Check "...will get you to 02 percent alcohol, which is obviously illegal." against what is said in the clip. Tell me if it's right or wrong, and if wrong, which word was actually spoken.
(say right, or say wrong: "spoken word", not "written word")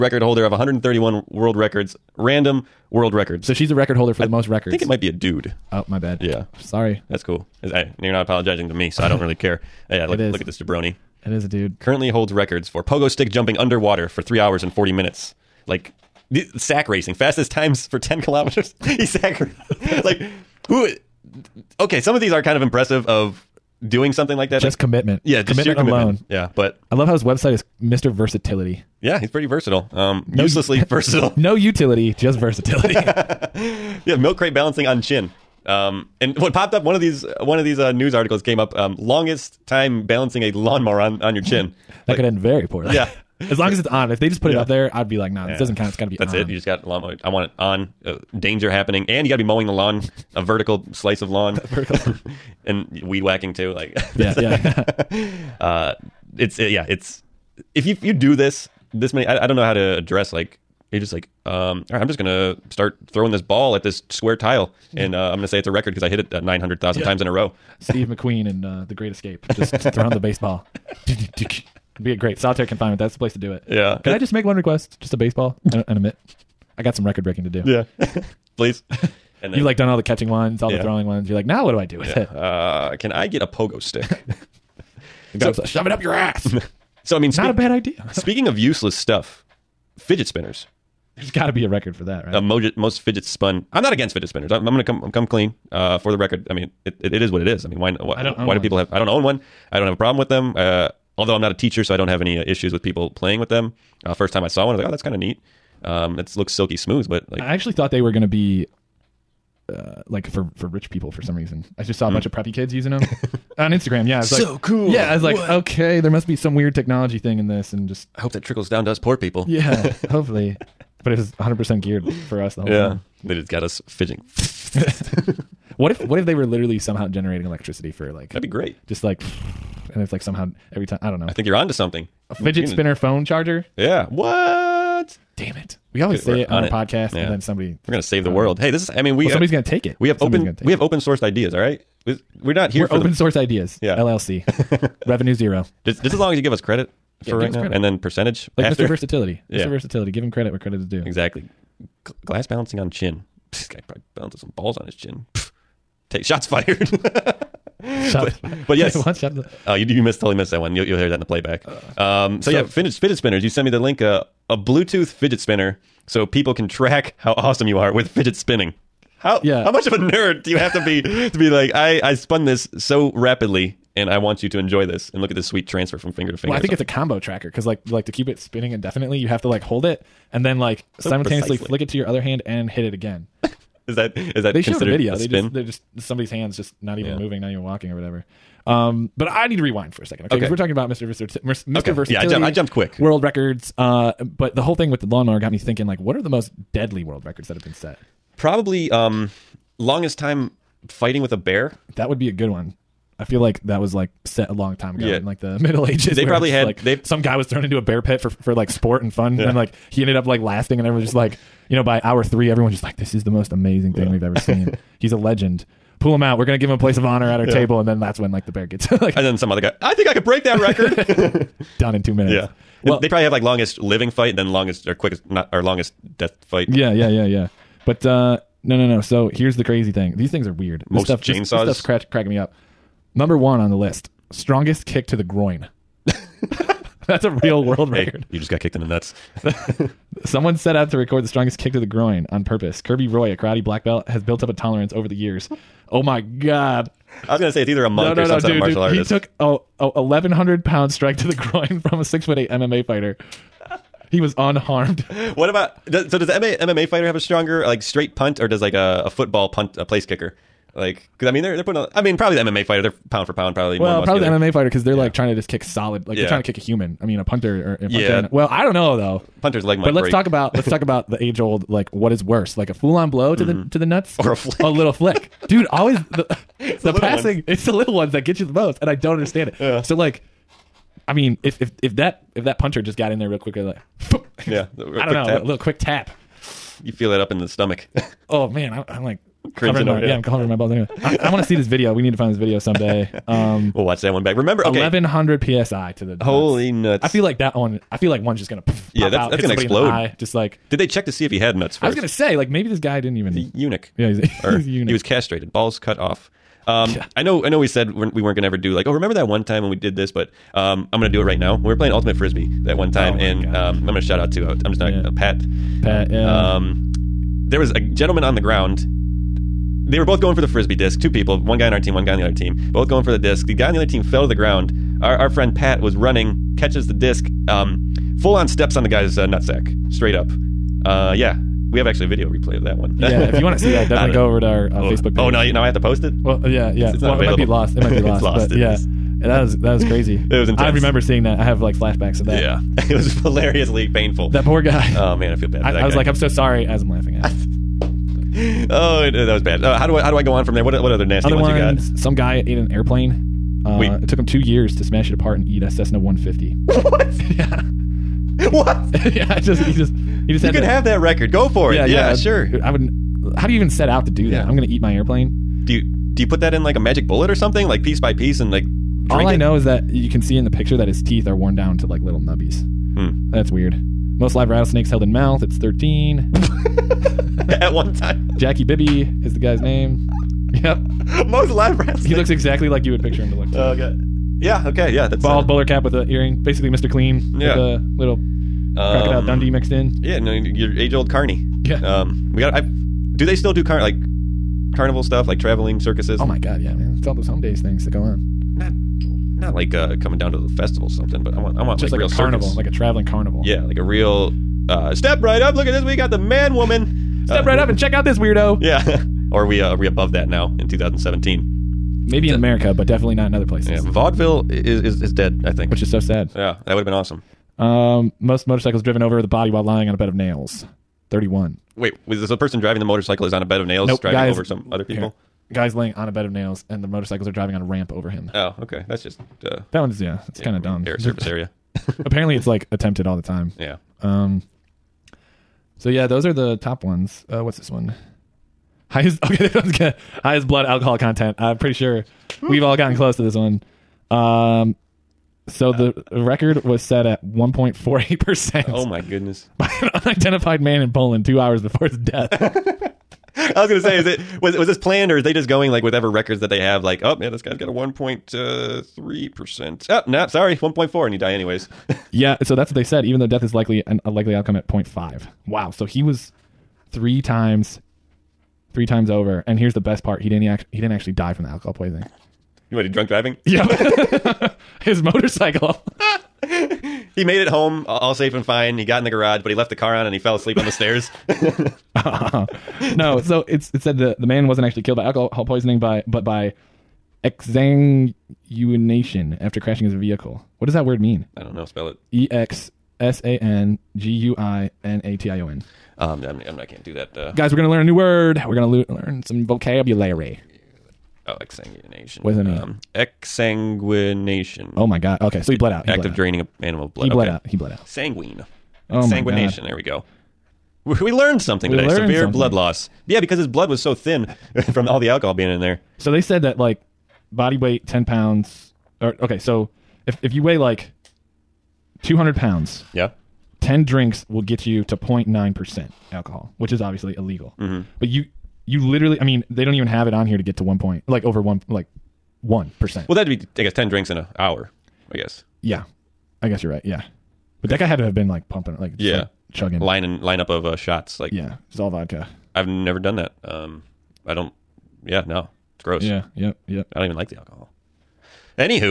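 wrong: "09", not "02".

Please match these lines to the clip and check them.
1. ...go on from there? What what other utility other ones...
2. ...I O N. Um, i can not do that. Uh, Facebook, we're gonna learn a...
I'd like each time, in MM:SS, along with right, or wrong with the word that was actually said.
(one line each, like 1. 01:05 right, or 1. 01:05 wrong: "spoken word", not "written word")
1. 05:50 wrong: "nasty", not "utility"
2. 08:15 wrong: "Guys", not "Facebook".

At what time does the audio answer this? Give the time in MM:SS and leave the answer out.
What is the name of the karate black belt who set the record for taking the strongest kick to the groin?
04:02.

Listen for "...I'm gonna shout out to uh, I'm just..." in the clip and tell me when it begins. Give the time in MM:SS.
05:13.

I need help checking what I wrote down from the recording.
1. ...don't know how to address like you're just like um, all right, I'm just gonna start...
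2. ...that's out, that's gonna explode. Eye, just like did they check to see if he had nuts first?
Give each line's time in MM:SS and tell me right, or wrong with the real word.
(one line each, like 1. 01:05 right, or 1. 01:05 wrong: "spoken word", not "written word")
1. 00:59 right
2. 04:59 right.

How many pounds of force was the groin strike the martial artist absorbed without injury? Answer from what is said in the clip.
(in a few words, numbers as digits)
1100.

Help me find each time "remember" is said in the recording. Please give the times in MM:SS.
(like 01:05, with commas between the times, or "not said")
04:54, 05:08, 05:40.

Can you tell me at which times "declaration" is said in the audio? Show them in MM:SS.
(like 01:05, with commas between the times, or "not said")
not said.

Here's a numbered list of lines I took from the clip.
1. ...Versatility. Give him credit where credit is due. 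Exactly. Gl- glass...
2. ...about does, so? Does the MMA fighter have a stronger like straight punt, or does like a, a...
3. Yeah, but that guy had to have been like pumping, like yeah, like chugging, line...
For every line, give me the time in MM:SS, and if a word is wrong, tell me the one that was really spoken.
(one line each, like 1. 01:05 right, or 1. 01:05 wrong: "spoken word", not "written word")
1. 02:29 right
2. 04:15 right
3. 08:56 right.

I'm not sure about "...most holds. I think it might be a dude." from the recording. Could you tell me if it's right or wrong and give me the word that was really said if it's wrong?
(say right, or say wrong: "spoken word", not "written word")
wrong: "records", not "holds".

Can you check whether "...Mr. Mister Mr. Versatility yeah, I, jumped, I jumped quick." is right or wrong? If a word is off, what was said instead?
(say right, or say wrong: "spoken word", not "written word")
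right.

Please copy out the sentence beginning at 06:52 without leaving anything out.
Maybe it's in a, America, but definitely not in other places.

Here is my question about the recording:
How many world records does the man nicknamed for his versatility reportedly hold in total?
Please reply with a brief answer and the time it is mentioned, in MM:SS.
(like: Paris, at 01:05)
131, at 00:00.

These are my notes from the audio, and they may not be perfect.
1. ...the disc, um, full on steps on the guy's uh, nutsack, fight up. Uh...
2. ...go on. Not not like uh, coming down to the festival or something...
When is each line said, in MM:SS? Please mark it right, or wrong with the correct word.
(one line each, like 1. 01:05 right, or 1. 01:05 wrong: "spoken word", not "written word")
1. 05:26 wrong: "straight", not "fight"
2. 06:37 right.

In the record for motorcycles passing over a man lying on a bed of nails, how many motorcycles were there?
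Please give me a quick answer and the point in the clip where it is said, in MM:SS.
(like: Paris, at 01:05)
31, at 07:01.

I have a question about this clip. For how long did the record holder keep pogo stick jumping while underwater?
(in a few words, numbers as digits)
3 hours and 40 minutes.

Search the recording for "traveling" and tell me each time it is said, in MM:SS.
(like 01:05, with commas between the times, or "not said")
06:35, 06:42.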